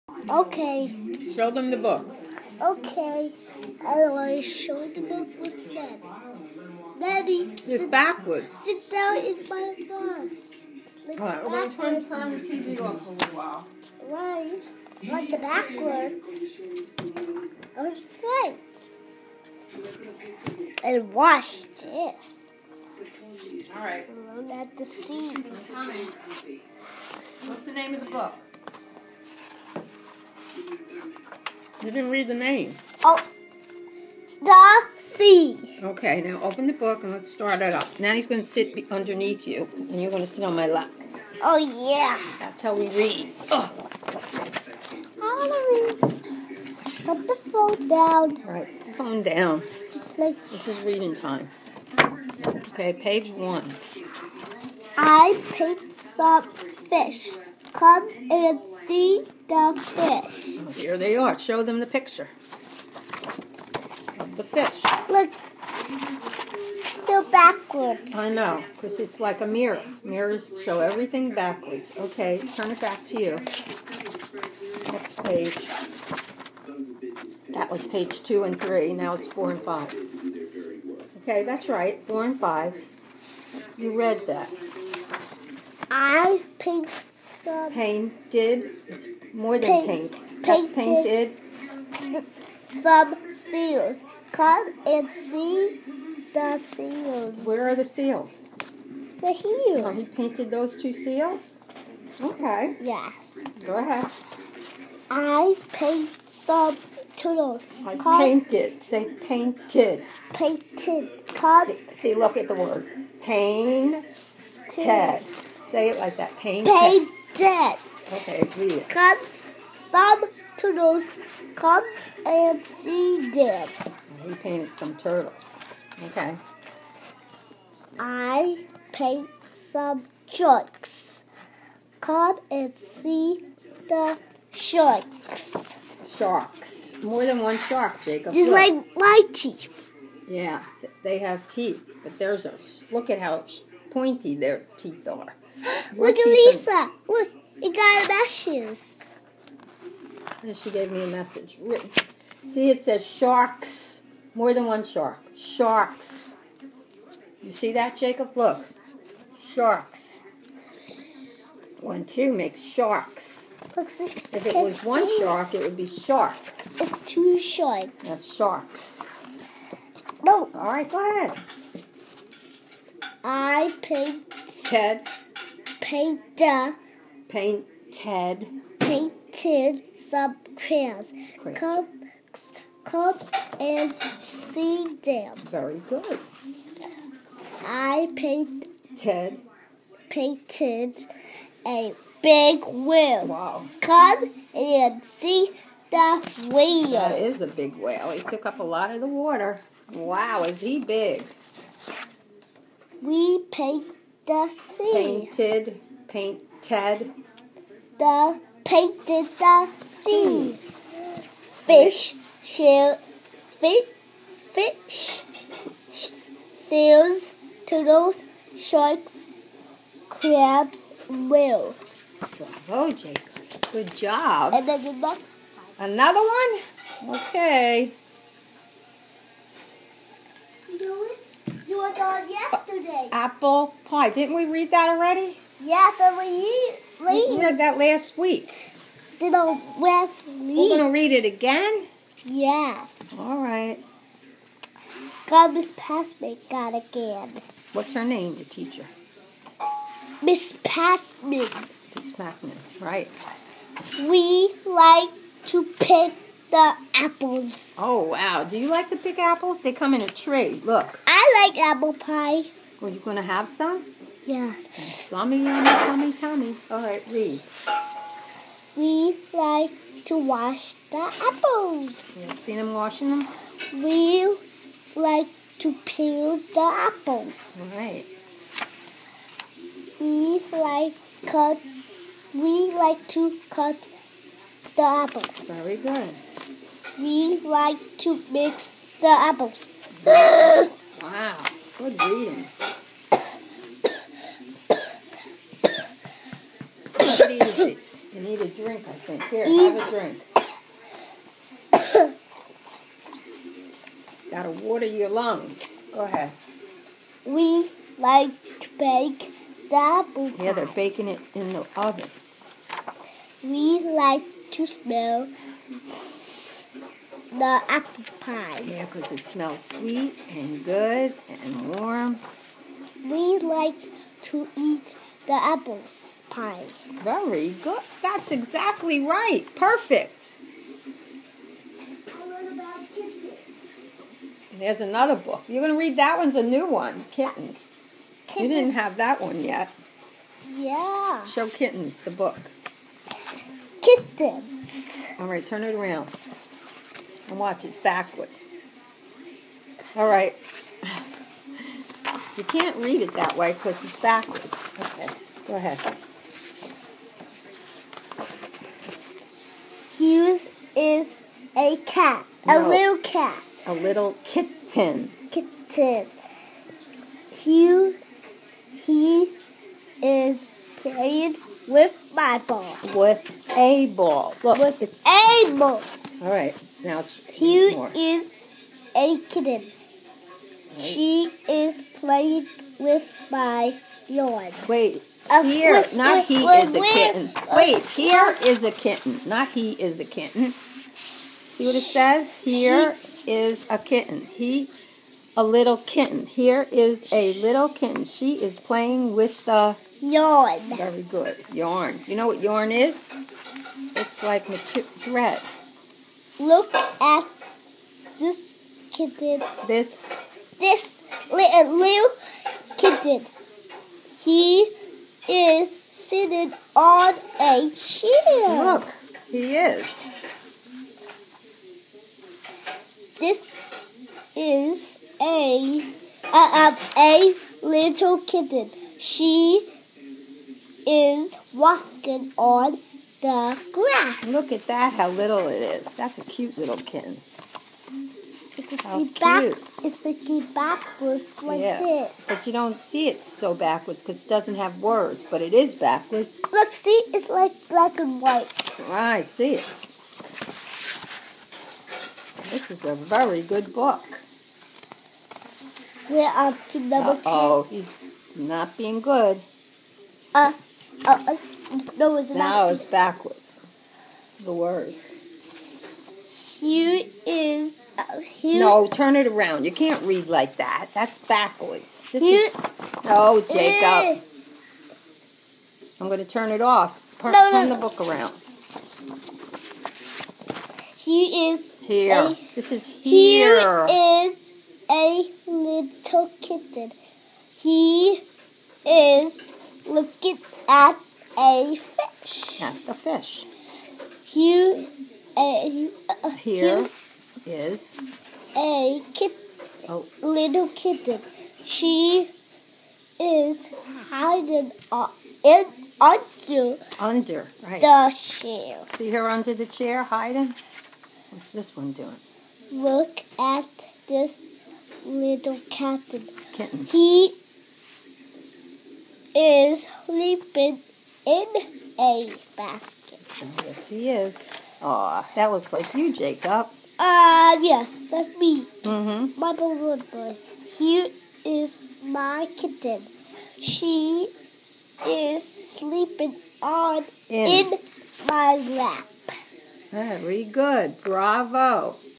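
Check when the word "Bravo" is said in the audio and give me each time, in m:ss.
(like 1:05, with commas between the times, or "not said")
3:42, 9:01.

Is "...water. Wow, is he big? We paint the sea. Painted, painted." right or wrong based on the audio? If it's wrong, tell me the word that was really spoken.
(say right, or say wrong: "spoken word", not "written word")
right.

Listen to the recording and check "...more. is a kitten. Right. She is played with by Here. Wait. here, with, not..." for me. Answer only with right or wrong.
wrong.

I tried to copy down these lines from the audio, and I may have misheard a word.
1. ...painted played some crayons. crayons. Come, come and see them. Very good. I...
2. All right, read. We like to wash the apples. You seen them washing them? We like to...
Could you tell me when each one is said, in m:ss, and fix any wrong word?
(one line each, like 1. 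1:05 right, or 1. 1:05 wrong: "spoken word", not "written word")
1. 2:57 wrong: "painted", not "played"
2. 4:26 right.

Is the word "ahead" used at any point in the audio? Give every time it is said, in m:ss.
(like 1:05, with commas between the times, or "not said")
1:43, 2:51, 5:06, 5:55.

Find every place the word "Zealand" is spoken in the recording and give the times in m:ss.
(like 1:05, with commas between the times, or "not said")
not said.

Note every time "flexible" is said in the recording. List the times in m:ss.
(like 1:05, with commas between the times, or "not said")
not said.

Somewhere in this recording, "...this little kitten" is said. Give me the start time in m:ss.
8:34.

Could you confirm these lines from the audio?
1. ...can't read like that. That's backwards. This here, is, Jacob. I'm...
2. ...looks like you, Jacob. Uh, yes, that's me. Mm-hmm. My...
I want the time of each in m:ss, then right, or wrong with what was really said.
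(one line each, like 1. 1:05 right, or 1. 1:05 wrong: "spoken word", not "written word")
1. 7:49 right
2. 8:45 right.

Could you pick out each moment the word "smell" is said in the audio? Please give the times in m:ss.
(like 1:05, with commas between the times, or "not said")
5:14, 5:19.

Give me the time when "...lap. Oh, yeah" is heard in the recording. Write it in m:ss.
0:40.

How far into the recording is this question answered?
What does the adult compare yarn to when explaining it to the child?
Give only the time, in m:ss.
6:44.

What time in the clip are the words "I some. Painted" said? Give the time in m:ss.
1:25.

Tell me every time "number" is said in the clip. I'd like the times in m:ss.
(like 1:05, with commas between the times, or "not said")
7:36.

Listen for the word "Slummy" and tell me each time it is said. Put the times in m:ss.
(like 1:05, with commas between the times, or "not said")
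4:24.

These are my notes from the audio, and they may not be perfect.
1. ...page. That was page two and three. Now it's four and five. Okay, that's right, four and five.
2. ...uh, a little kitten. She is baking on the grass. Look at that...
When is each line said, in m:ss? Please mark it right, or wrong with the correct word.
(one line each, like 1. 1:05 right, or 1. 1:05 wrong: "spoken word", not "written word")
1. 1:15 right
2. 7:06 wrong: "walking", not "baking".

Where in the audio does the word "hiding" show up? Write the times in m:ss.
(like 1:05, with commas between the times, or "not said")
8:24, 8:30.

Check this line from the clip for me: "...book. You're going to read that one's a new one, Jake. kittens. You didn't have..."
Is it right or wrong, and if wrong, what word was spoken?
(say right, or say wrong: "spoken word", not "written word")
wrong: "Kittens", not "Jake".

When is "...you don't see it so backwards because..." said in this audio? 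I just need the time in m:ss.
7:22.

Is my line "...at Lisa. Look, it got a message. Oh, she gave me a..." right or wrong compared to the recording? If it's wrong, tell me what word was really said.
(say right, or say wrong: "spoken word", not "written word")
right.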